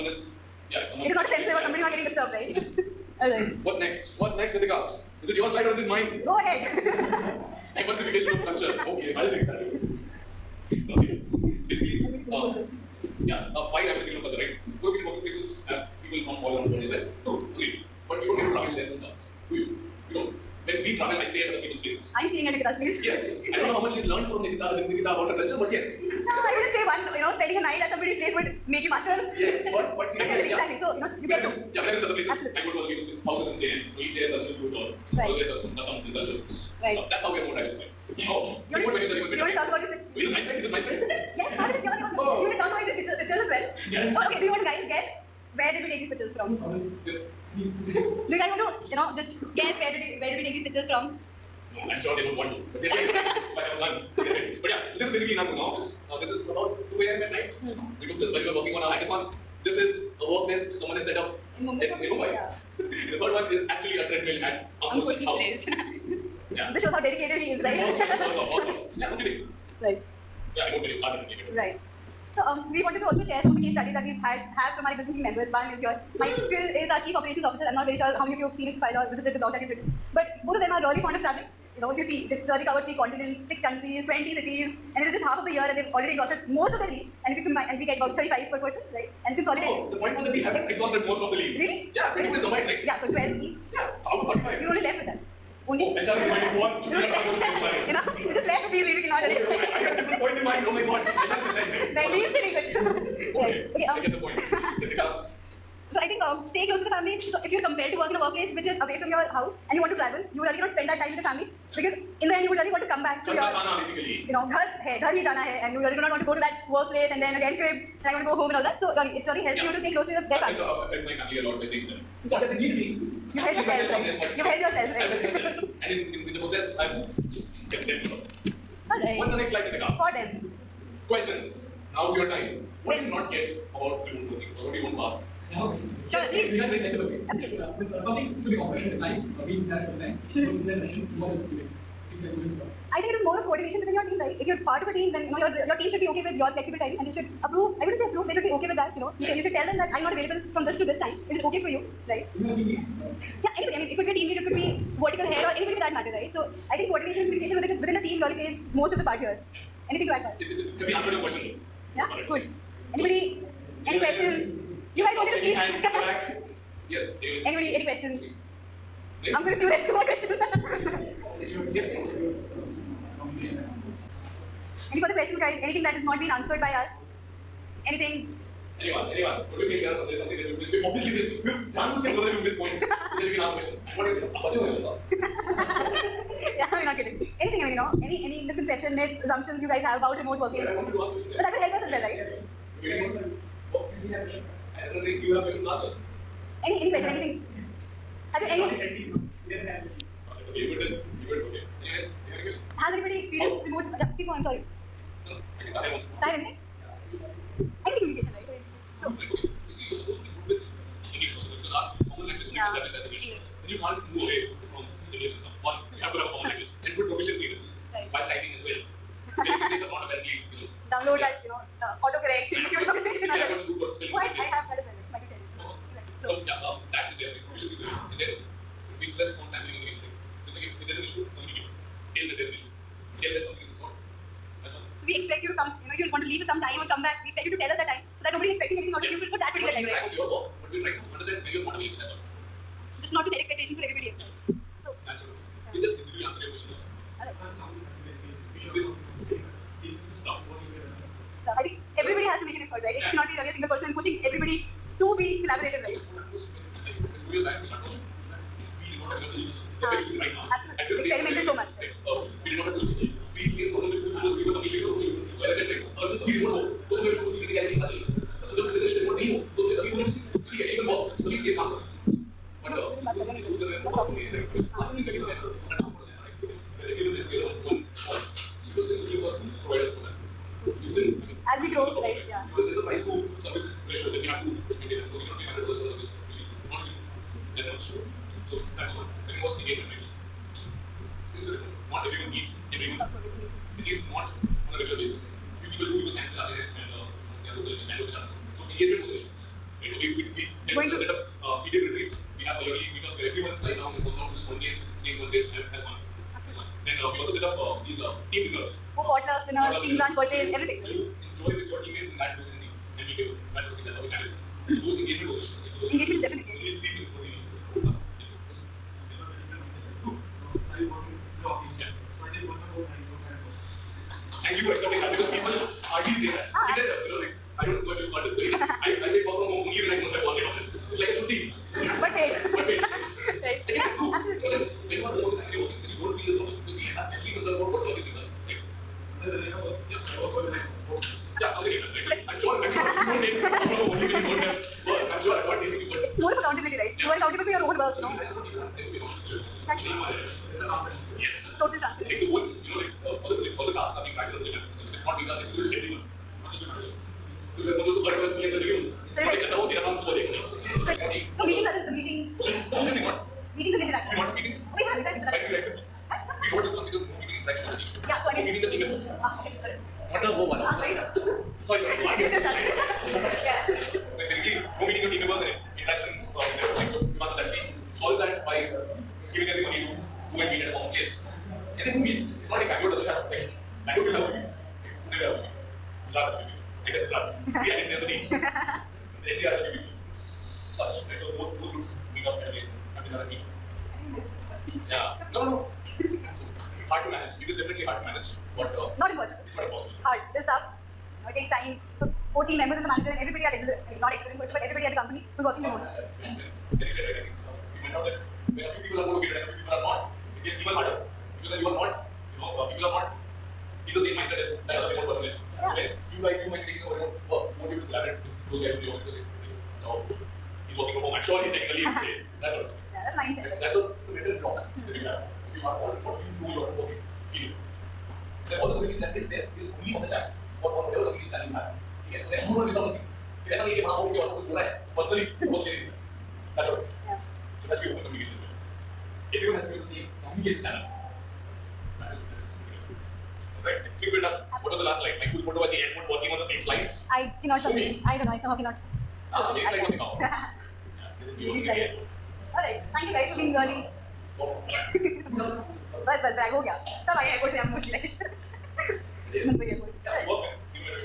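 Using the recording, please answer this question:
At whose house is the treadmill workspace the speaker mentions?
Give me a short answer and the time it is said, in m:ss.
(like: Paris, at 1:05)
Ankur, at 1:04.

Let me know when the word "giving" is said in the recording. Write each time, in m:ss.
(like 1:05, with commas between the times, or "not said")
6:08.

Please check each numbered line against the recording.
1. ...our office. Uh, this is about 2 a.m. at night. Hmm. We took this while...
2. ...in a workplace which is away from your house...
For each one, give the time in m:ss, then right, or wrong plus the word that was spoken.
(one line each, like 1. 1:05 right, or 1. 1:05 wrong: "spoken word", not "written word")
1. 0:55 right
2. 1:48 right.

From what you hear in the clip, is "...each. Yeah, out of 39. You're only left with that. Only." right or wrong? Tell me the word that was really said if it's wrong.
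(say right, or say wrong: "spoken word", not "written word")
wrong: "35", not "39".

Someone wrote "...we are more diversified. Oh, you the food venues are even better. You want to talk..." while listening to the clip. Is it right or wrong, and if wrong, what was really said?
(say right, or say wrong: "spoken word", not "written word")
right.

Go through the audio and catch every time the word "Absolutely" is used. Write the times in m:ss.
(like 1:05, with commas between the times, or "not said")
0:32, 2:17, 4:20.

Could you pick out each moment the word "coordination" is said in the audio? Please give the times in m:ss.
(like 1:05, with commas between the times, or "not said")
2:23, 2:36.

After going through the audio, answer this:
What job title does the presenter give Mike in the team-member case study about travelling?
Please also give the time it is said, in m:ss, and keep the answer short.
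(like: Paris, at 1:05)
Chief Operations Officer, at 1:17.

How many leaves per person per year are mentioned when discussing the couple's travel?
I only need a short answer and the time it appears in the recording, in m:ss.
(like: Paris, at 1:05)
35, at 1:28.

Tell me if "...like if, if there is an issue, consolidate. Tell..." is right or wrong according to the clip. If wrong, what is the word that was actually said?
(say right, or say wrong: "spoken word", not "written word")
wrong: "communicate", not "consolidate".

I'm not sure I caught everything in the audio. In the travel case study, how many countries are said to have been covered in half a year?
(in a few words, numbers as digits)
6.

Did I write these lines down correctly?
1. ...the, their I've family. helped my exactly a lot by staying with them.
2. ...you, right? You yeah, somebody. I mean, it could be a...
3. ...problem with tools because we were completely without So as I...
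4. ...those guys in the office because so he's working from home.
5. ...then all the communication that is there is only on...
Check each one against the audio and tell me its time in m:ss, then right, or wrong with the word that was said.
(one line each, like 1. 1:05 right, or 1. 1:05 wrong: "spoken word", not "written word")
1. 2:00 wrong: "family", not "exactly"
2. 2:31 wrong: "anybody", not "somebody"
3. 4:23 right
4. 6:58 right
5. 7:08 right.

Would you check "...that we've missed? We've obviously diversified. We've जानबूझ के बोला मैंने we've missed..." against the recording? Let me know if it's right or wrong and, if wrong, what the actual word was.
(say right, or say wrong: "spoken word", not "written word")
wrong: "missed", not "diversified".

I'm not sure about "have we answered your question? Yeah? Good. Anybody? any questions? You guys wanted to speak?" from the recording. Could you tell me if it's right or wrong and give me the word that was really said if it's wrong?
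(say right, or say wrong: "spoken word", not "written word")
right.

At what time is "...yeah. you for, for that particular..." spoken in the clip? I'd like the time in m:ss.
3:59.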